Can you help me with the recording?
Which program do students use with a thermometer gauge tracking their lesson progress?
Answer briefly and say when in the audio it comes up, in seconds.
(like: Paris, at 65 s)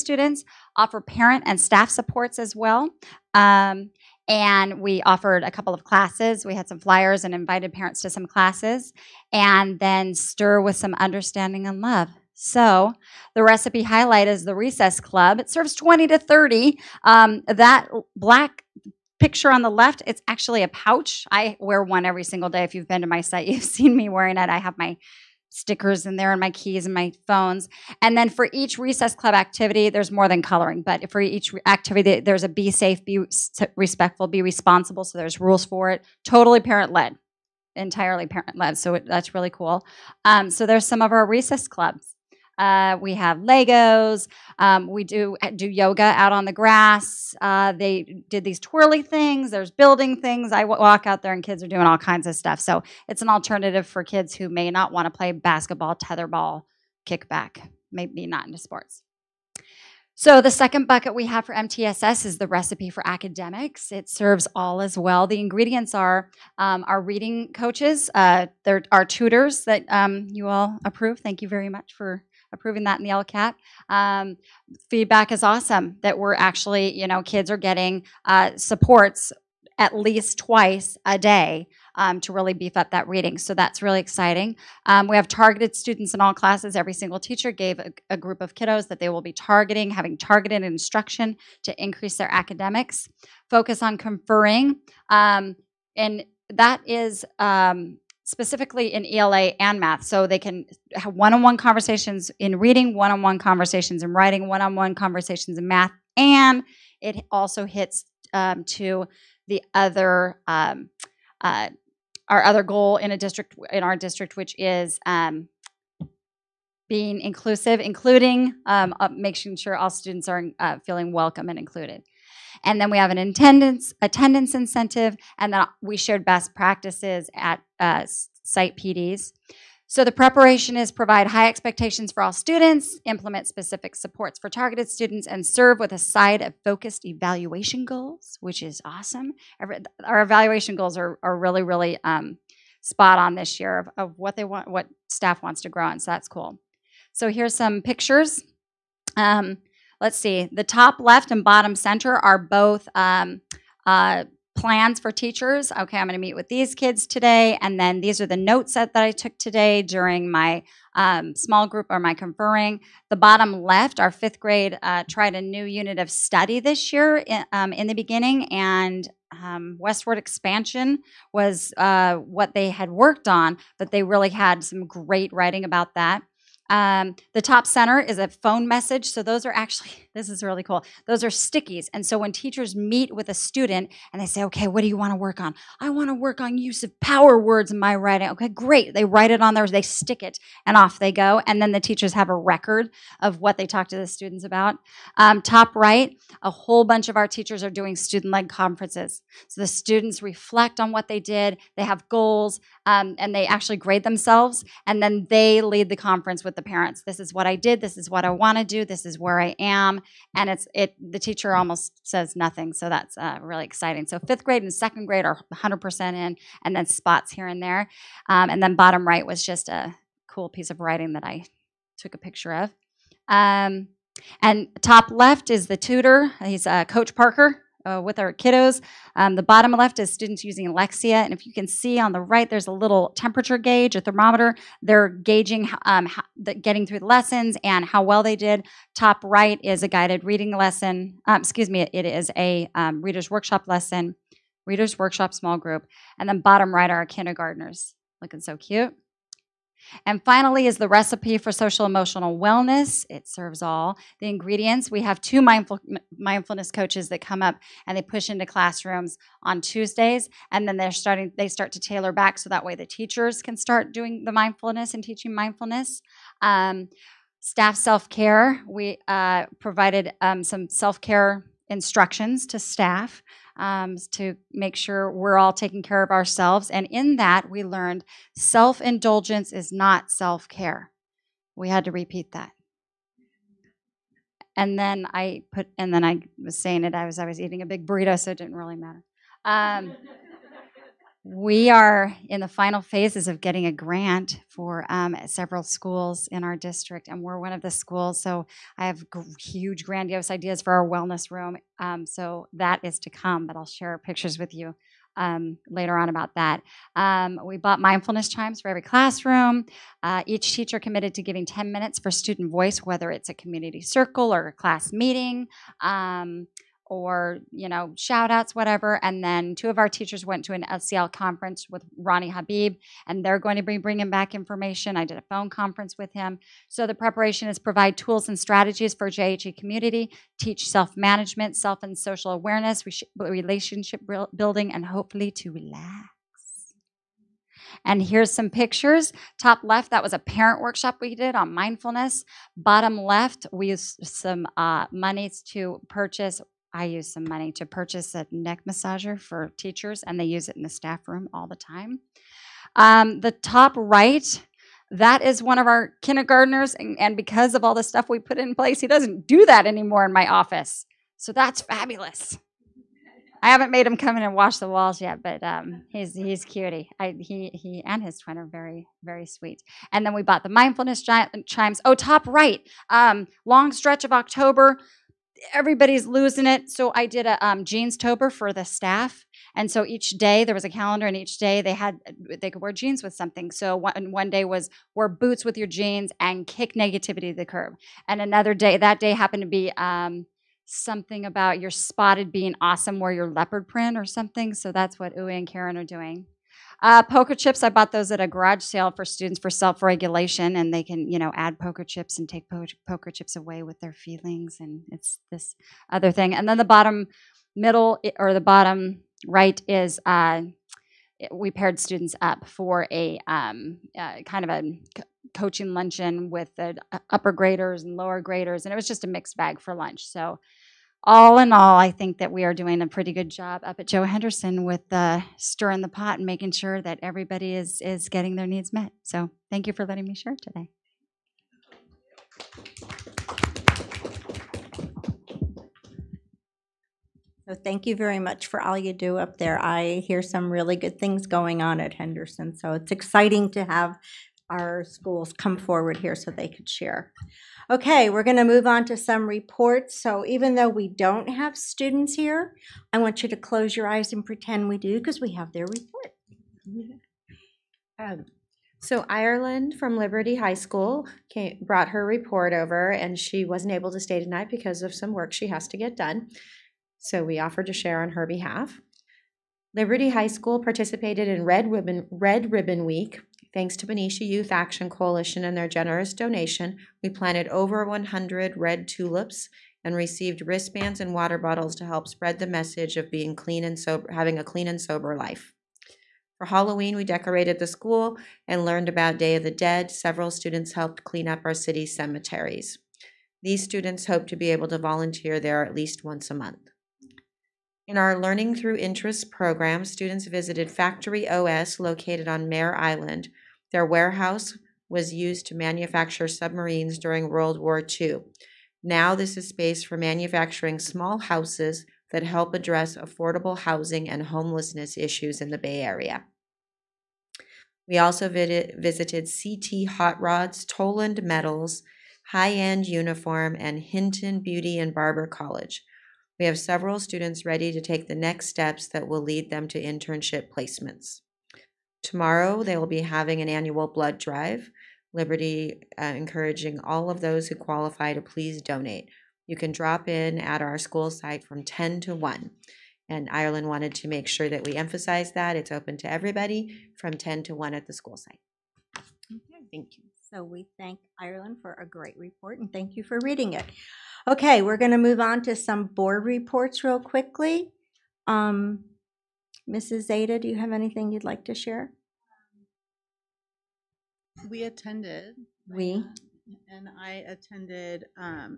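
Alexia, at 230 s.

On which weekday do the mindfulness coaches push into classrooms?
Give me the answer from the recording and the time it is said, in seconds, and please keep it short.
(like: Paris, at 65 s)
Tuesdays, at 259 s.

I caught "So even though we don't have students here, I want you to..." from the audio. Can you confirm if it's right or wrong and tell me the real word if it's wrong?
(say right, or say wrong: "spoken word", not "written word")
right.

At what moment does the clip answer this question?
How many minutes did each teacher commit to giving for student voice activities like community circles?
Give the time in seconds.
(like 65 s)
311 s.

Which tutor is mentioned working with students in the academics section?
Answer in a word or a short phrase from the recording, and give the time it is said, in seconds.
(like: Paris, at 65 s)
Coach Parker, at 226 s.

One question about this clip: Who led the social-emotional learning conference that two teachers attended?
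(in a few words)
Ronnie Habib.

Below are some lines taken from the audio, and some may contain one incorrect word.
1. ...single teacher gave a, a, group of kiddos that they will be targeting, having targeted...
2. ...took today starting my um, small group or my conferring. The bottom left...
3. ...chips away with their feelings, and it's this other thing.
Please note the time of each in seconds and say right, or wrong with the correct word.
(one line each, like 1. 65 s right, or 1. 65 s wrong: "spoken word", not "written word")
1. 86 s right
2. 159 s wrong: "during", not "starting"
3. 403 s right.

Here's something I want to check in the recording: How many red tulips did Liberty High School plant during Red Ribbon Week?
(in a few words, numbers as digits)
over 100.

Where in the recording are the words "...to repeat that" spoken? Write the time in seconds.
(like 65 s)
281 s.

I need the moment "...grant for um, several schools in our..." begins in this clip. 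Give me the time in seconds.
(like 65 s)
293 s.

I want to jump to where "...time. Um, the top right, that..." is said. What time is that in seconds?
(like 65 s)
351 s.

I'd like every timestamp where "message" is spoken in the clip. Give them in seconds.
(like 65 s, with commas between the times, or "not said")
178 s, 482 s.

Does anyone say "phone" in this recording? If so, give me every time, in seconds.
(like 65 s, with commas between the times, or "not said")
27 s, 178 s, 325 s.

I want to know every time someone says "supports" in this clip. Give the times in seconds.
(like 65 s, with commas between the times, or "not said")
1 s, 78 s, 133 s.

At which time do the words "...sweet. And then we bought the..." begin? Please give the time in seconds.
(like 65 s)
369 s.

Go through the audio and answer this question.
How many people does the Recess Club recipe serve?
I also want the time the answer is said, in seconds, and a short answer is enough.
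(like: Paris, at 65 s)
20 to 30, at 15 s.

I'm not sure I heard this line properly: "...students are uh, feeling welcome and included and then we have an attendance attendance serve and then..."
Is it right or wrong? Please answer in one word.
wrong.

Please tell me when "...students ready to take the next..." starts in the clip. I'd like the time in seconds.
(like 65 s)
527 s.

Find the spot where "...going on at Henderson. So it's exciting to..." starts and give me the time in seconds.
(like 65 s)
441 s.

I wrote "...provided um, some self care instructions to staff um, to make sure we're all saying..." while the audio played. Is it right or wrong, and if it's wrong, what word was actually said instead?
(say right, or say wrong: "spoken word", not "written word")
wrong: "taking", not "saying".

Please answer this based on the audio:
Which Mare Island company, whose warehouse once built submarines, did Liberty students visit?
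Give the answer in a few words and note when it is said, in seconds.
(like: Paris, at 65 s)
Factory OS, at 500 s.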